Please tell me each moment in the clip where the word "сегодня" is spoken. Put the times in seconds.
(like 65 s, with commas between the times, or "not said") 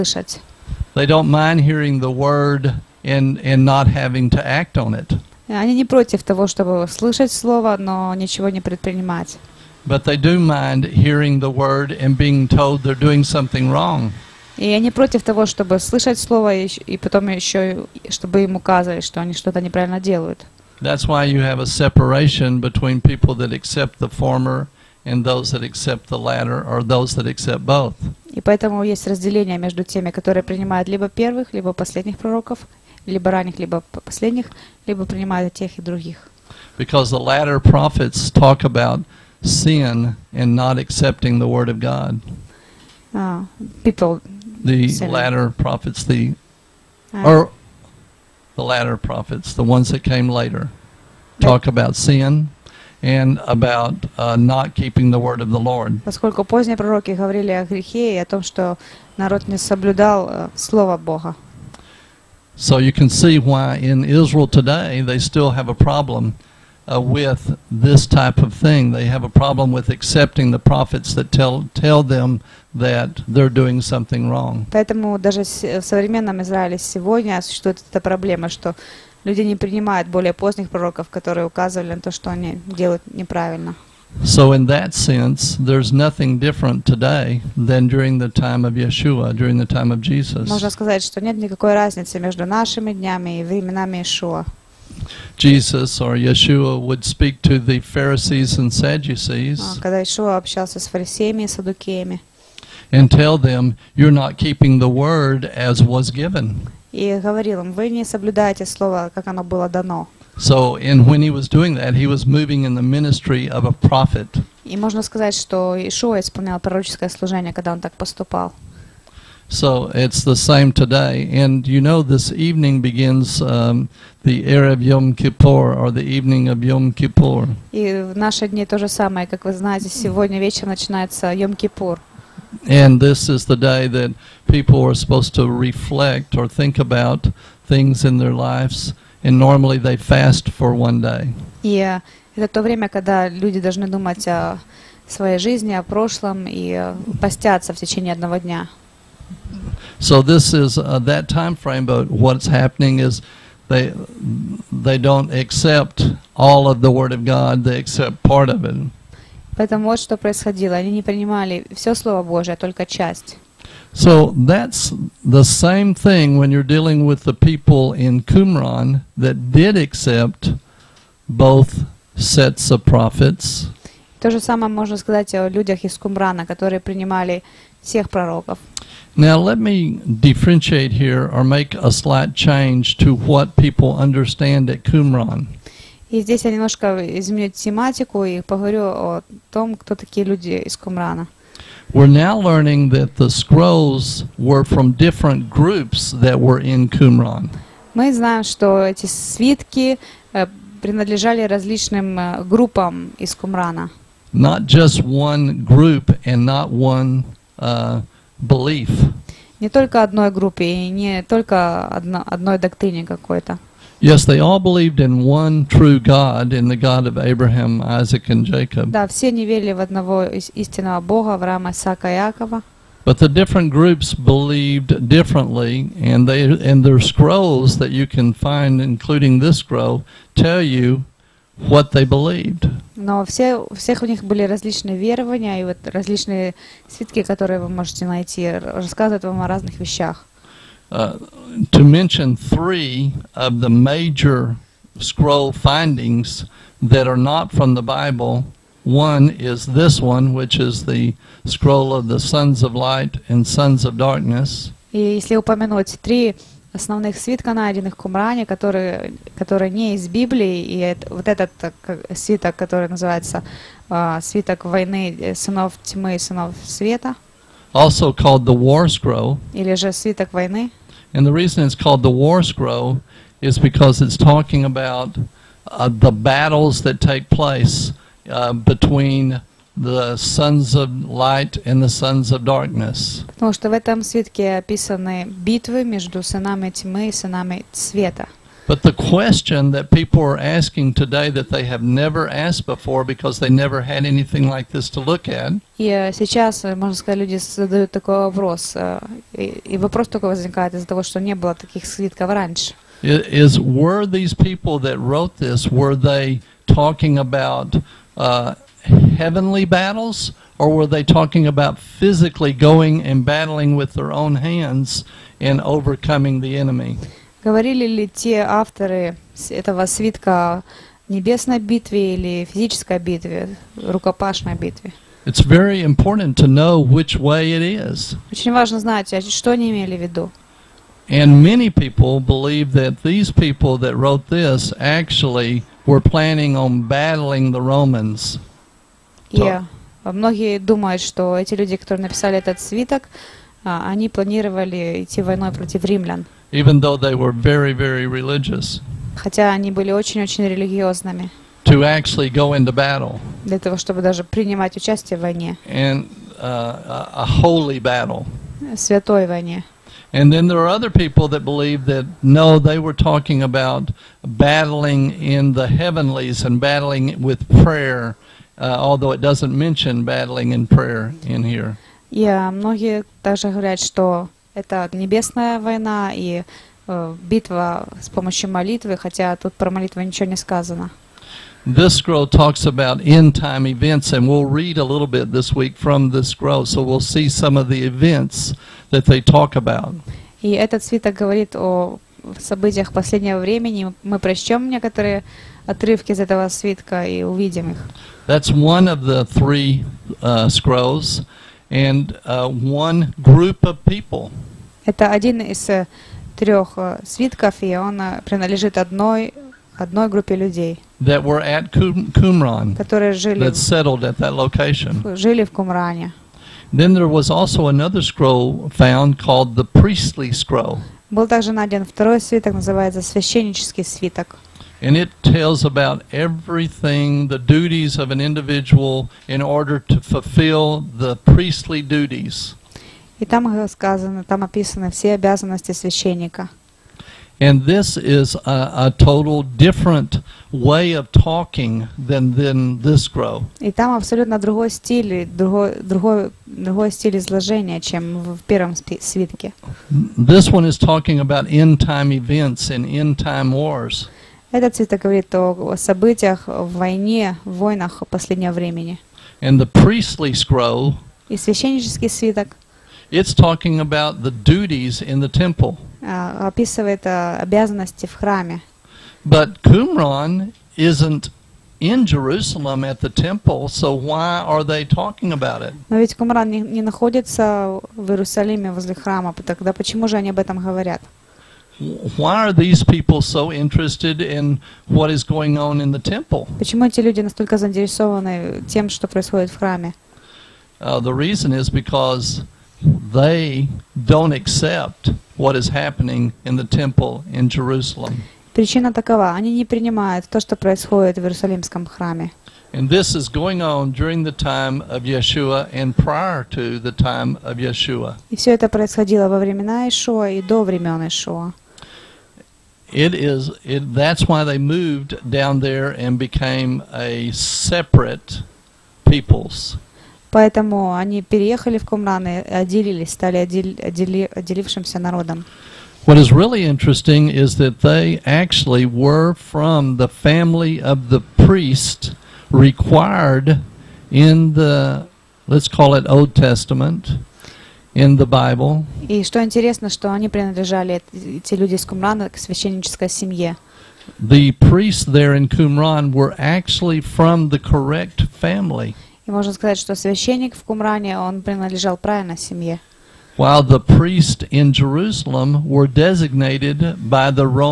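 76 s, 129 s.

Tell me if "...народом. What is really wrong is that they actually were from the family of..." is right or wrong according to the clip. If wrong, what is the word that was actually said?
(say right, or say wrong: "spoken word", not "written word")
wrong: "interesting", not "wrong".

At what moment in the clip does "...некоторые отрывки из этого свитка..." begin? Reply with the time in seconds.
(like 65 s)
394 s.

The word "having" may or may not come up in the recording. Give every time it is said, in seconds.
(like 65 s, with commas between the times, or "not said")
3 s.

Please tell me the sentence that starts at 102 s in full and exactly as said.
And tell them, you're not keeping the word as was given.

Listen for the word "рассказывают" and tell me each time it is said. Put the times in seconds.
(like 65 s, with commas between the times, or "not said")
238 s.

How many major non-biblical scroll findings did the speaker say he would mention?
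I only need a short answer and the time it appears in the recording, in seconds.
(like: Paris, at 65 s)
3, at 242 s.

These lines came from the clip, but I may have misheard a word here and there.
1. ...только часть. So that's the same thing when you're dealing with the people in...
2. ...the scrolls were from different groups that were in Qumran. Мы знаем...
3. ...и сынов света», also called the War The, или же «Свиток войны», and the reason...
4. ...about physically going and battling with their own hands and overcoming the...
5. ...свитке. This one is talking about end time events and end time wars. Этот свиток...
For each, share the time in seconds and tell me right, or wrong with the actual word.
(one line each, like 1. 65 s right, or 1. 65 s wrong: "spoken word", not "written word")
1. 162 s right
2. 193 s right
3. 266 s wrong: "Scroll", not "The"
4. 311 s right
5. 448 s right.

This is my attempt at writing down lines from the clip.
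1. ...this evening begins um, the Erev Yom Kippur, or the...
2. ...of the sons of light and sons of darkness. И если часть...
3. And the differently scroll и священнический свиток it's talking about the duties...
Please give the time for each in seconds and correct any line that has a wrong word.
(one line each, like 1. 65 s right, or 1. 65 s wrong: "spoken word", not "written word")
1. 122 s right
2. 251 s wrong: "упомянуть", not "часть"
3. 459 s wrong: "priestly", not "differently".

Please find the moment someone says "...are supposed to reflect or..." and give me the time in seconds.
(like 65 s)
134 s.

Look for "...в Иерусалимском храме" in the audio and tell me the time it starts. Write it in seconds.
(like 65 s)
501 s.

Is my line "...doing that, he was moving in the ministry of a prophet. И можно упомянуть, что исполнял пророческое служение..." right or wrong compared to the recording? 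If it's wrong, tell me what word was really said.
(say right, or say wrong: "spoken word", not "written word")
wrong: "сказать", not "упомянуть".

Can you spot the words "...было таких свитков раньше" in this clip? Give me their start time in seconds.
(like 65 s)
301 s.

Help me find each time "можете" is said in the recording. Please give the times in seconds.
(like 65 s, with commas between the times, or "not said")
237 s.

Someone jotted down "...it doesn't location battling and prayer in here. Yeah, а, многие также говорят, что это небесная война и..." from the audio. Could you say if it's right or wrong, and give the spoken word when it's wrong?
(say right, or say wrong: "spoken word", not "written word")
wrong: "mention", not "location".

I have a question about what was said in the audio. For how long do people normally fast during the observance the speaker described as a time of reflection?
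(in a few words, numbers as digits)
One day.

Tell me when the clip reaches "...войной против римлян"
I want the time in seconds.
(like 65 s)
345 s.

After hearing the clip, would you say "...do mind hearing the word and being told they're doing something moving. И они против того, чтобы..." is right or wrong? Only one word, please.
wrong.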